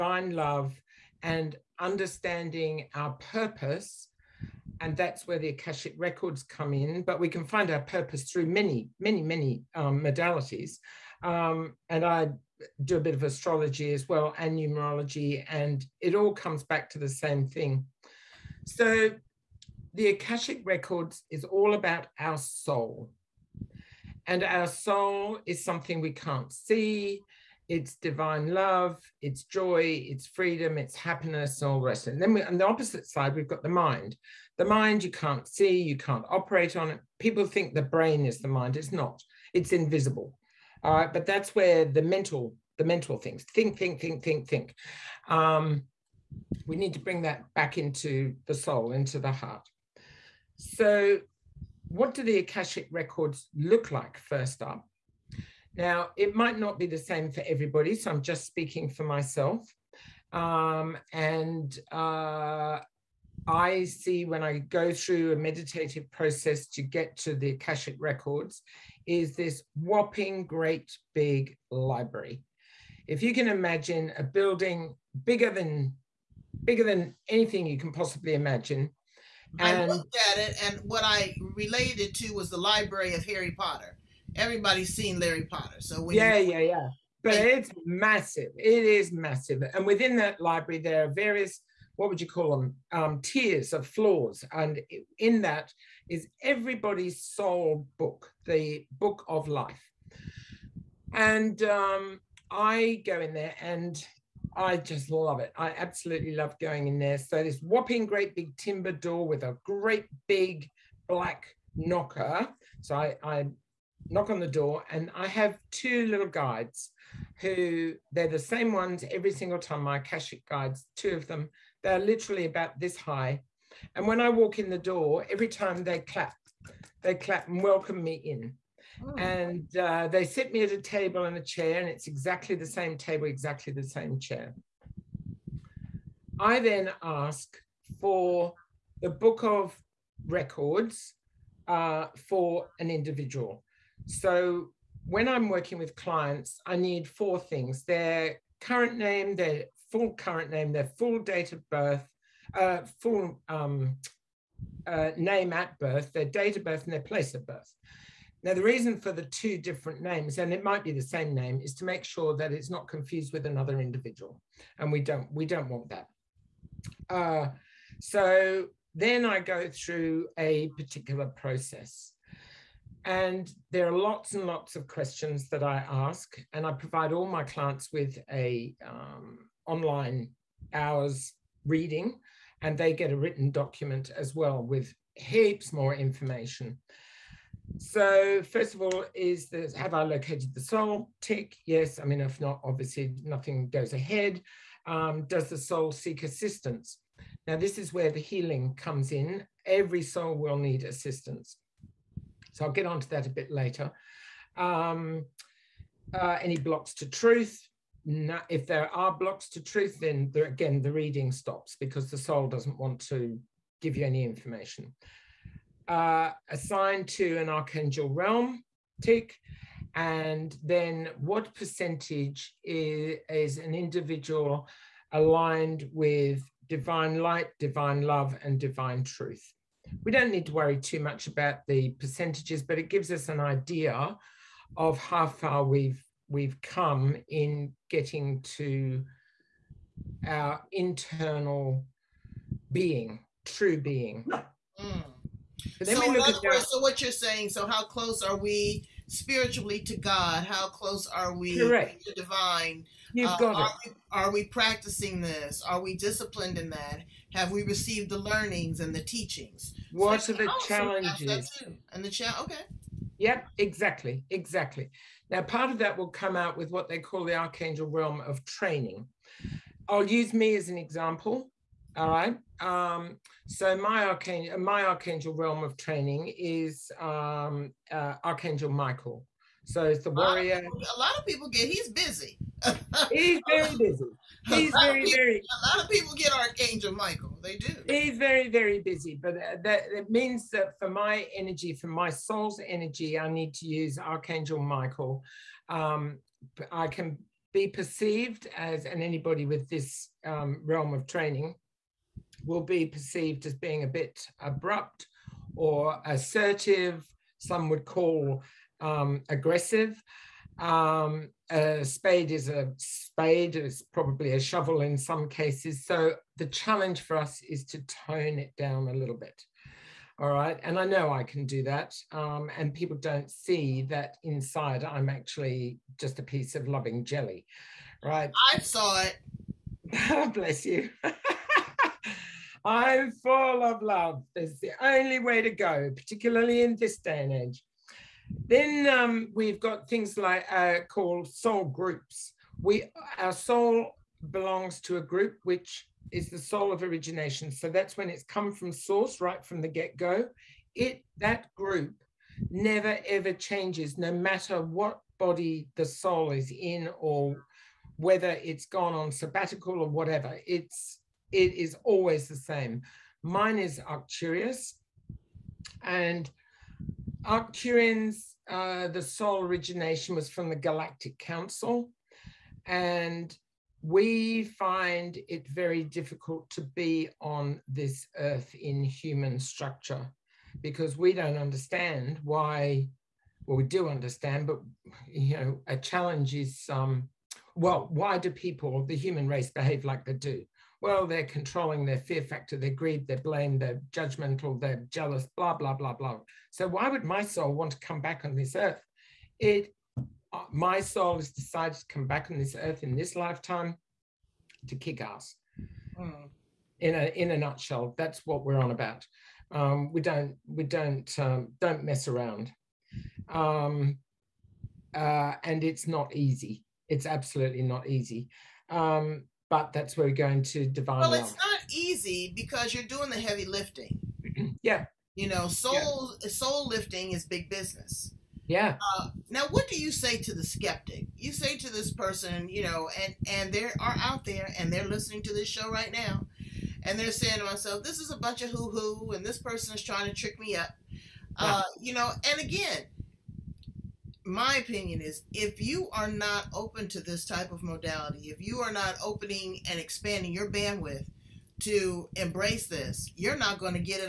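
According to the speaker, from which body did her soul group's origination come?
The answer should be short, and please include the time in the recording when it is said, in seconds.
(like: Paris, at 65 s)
the Galactic Council, at 370 s.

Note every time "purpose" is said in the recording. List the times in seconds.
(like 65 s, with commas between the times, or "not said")
3 s, 7 s.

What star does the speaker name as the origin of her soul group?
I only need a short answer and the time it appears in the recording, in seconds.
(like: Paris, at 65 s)
Arcturus, at 363 s.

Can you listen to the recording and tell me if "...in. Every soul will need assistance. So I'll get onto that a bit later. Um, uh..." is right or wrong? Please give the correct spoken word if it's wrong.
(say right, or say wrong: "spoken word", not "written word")
right.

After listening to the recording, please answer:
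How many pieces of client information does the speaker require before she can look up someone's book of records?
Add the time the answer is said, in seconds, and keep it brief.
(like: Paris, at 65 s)
4, at 147 s.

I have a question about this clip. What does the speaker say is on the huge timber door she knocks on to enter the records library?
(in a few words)
a great big black knocker.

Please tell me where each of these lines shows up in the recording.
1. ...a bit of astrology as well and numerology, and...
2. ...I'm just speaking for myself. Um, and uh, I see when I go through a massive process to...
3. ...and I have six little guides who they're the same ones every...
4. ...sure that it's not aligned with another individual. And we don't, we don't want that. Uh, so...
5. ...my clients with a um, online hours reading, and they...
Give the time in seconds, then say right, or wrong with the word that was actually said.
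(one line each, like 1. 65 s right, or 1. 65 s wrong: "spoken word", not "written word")
1. 12 s right
2. 58 s wrong: "meditative", not "massive"
3. 114 s wrong: "two", not "six"
4. 162 s wrong: "confused", not "aligned"
5. 177 s right.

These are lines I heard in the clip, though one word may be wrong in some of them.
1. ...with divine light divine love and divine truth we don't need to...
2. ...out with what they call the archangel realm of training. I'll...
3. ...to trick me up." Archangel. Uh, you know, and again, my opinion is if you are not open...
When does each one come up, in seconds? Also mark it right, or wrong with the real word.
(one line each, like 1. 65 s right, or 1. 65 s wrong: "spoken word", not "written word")
1. 225 s right
2. 266 s right
3. 440 s wrong: "Yeah", not "Archangel".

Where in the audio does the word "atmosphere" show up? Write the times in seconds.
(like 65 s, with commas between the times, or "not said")
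not said.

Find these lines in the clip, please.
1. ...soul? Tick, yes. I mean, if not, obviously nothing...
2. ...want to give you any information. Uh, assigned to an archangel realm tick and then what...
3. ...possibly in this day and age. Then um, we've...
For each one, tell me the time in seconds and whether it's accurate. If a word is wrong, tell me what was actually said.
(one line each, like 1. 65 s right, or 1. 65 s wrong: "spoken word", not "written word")
1. 190 s right
2. 212 s right
3. 335 s wrong: "particularly", not "possibly".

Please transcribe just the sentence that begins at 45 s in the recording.
Um, we need to bring that back into the soul, into the heart.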